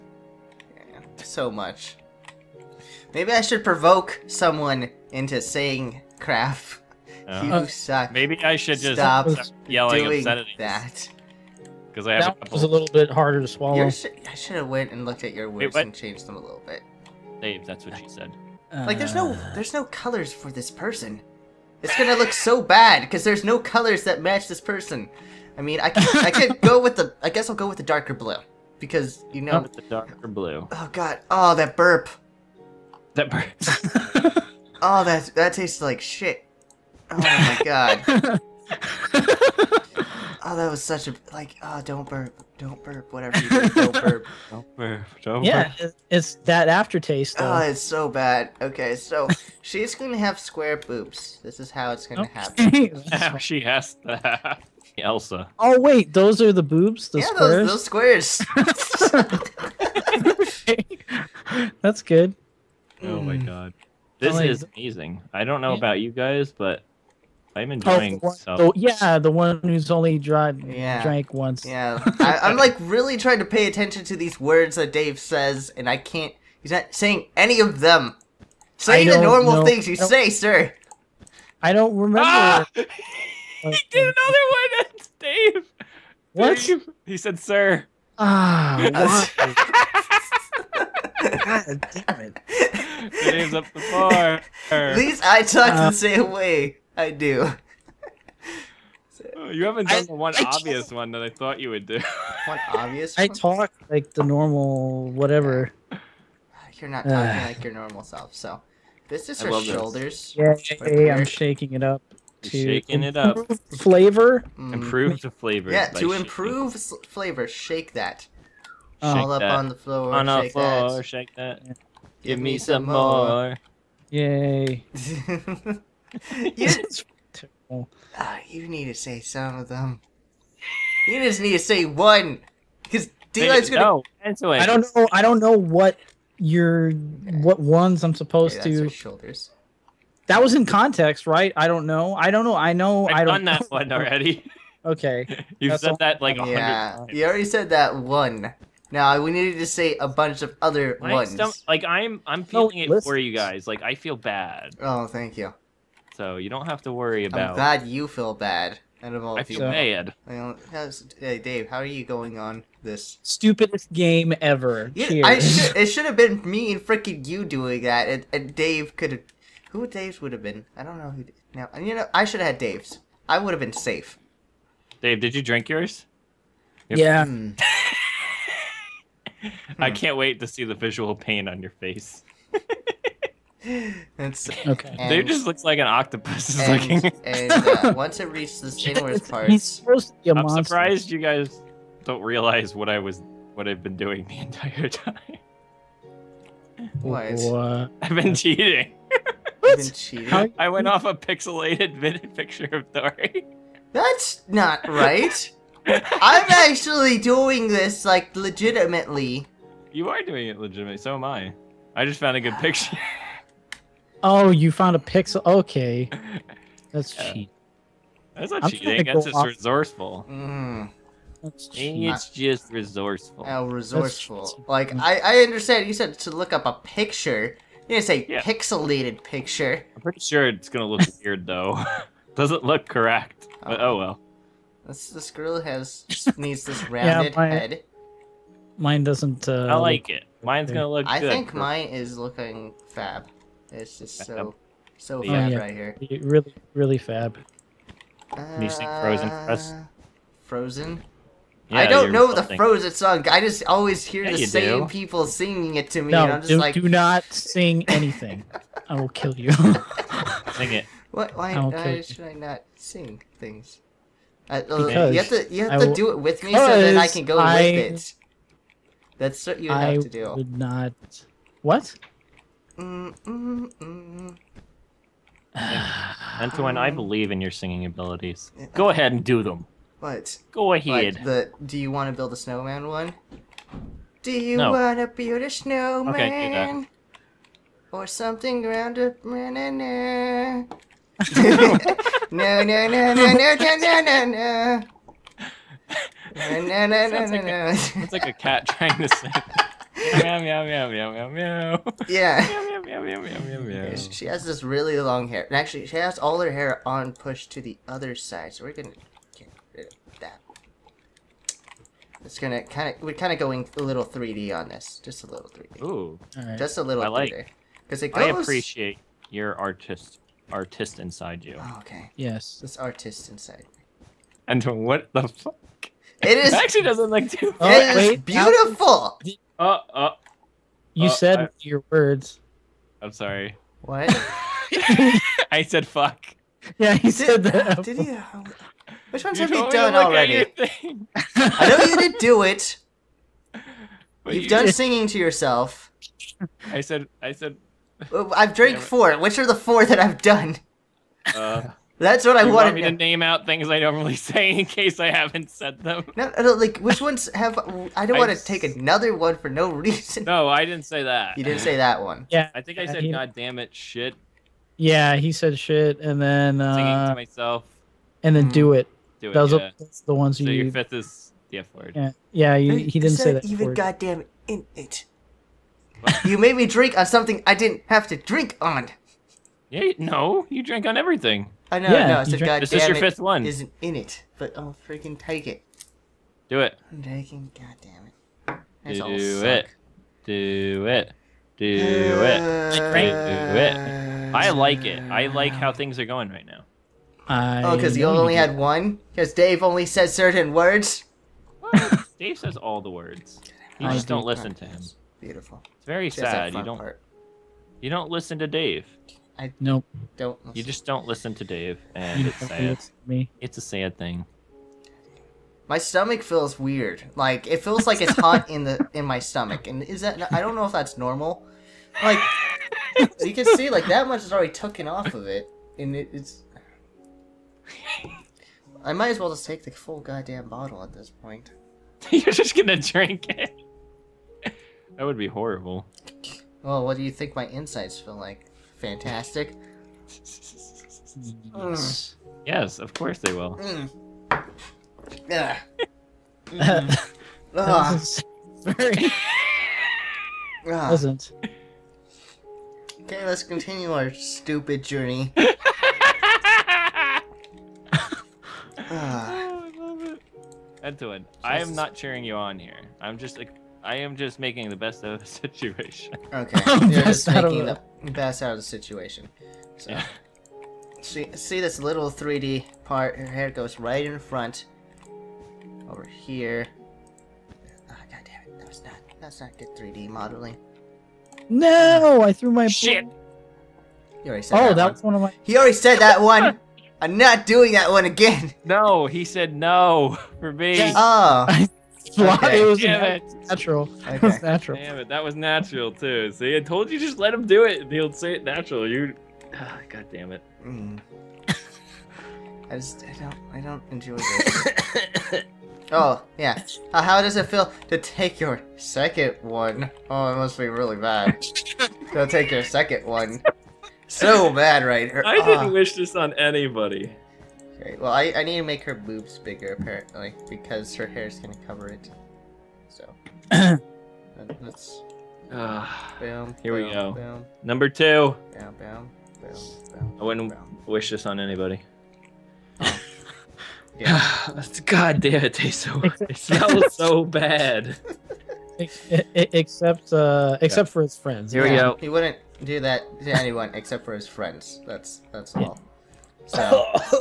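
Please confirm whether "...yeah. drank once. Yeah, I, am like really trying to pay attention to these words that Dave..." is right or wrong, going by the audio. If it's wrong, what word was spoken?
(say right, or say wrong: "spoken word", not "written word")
right.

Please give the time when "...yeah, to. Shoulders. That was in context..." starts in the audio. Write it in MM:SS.
02:18.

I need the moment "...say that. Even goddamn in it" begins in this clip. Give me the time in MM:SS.
06:13.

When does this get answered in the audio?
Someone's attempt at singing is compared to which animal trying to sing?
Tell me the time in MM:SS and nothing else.
04:58.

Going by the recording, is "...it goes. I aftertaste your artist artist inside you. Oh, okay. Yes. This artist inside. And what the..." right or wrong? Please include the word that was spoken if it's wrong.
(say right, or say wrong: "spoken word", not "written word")
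wrong: "appreciate", not "aftertaste".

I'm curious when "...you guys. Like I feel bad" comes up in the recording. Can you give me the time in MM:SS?
02:33.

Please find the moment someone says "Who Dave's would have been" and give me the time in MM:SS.
02:49.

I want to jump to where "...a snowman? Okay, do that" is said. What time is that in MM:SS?
04:45.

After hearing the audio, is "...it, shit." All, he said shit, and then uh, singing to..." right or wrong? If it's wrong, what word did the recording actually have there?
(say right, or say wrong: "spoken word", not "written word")
wrong: "Yeah", not "All".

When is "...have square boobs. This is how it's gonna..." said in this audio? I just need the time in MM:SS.
00:50.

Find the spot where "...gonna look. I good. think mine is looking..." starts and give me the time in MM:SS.
04:00.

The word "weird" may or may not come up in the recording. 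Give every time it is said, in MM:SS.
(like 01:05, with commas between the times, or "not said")
03:51, 06:56.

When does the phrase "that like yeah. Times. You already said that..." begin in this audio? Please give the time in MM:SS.
02:25.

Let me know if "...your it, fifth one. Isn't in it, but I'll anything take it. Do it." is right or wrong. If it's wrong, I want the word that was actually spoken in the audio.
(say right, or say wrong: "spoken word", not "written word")
wrong: "freaking", not "anything".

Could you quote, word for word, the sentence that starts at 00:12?
was a little bit harder to swallow.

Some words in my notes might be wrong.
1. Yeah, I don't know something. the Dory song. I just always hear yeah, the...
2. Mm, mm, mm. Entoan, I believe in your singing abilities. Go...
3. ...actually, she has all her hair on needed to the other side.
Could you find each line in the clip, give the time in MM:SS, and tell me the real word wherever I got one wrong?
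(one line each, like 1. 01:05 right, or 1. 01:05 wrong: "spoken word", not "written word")
1. 04:11 wrong: "Frozen", not "Dory"
2. 04:32 right
3. 05:05 wrong: "pushed", not "needed".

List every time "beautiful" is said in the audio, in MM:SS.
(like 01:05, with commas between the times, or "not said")
05:28, 06:45.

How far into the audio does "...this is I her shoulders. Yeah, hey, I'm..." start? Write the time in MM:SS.
01:49.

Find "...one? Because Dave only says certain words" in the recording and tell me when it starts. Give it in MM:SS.
06:38.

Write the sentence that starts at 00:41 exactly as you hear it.
Oh, don't burp, don't burp, whatever.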